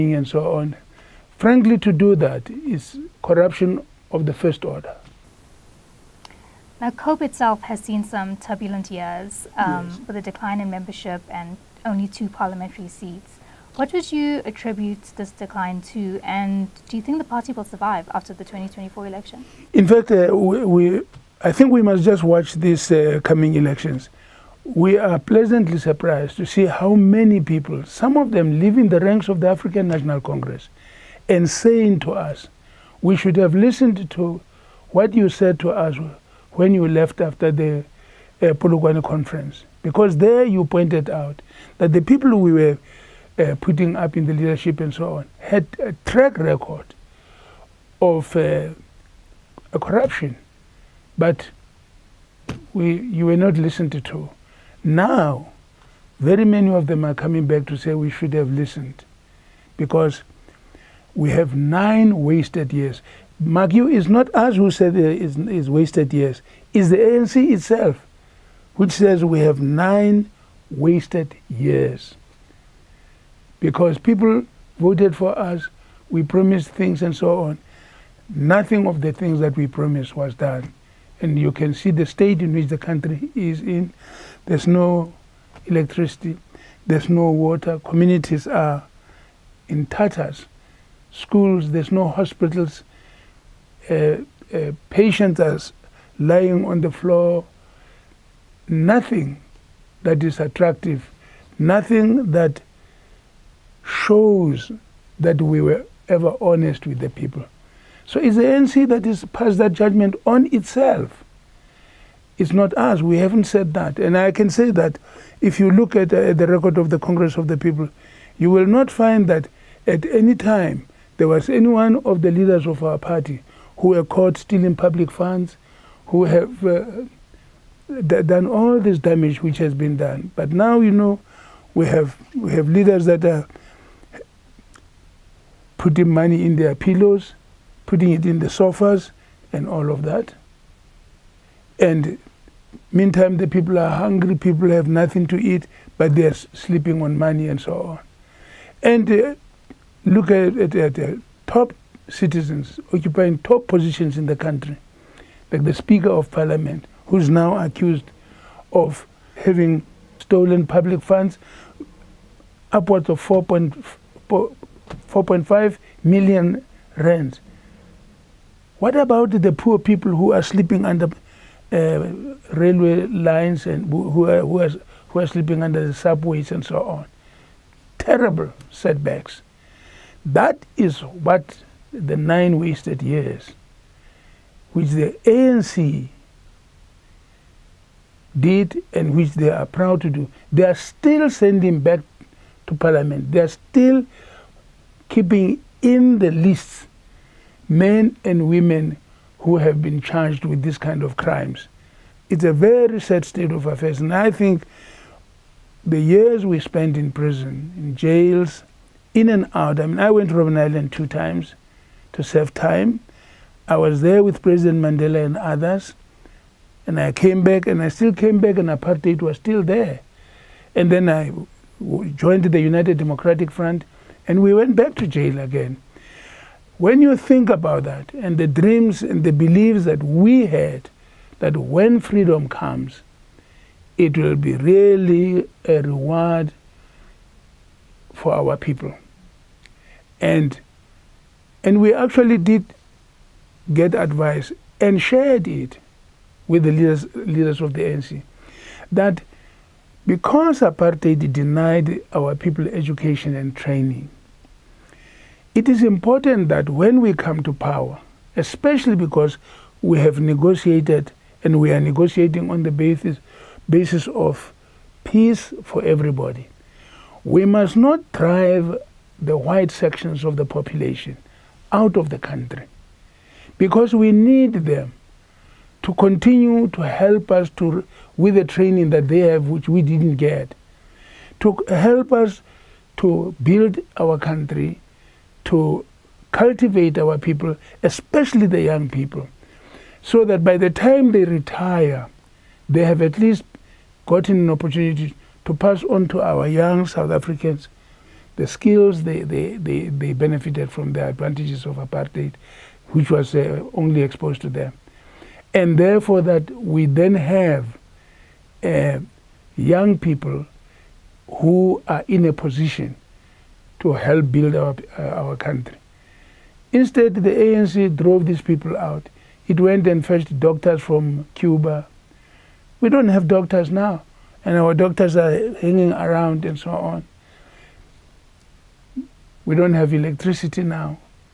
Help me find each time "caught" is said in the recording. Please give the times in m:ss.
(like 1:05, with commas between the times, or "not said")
2:04.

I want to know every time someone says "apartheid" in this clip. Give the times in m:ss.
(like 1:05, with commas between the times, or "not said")
3:38, 4:10, 5:01.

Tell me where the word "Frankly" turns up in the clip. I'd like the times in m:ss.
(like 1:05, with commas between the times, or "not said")
0:01.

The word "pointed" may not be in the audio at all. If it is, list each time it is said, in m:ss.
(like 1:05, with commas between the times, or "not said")
0:40.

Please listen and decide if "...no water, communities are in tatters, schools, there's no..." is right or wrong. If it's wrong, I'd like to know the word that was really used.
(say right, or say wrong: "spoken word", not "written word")
right.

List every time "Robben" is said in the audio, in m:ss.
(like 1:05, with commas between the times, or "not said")
3:30.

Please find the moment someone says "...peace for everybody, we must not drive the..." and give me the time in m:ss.
4:25.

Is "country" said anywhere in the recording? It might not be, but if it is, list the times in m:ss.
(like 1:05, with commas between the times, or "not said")
1:22, 2:34, 4:32, 4:44, 5:15.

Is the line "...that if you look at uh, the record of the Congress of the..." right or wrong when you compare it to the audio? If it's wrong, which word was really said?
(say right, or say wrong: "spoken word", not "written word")
right.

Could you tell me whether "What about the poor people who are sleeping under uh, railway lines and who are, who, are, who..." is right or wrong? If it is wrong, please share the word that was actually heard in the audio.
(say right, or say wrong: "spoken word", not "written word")
right.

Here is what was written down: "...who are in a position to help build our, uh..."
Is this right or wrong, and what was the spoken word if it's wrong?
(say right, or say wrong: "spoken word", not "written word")
right.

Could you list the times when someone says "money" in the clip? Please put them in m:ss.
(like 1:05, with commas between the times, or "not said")
2:16, 2:27.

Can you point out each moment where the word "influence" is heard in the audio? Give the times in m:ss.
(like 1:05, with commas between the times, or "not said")
not said.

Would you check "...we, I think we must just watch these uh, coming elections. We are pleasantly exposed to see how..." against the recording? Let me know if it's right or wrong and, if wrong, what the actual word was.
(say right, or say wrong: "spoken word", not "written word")
wrong: "surprised", not "exposed".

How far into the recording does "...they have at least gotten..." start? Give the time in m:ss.
4:52.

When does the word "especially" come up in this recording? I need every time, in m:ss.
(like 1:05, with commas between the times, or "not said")
4:18, 4:47.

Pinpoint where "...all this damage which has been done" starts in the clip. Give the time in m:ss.
2:08.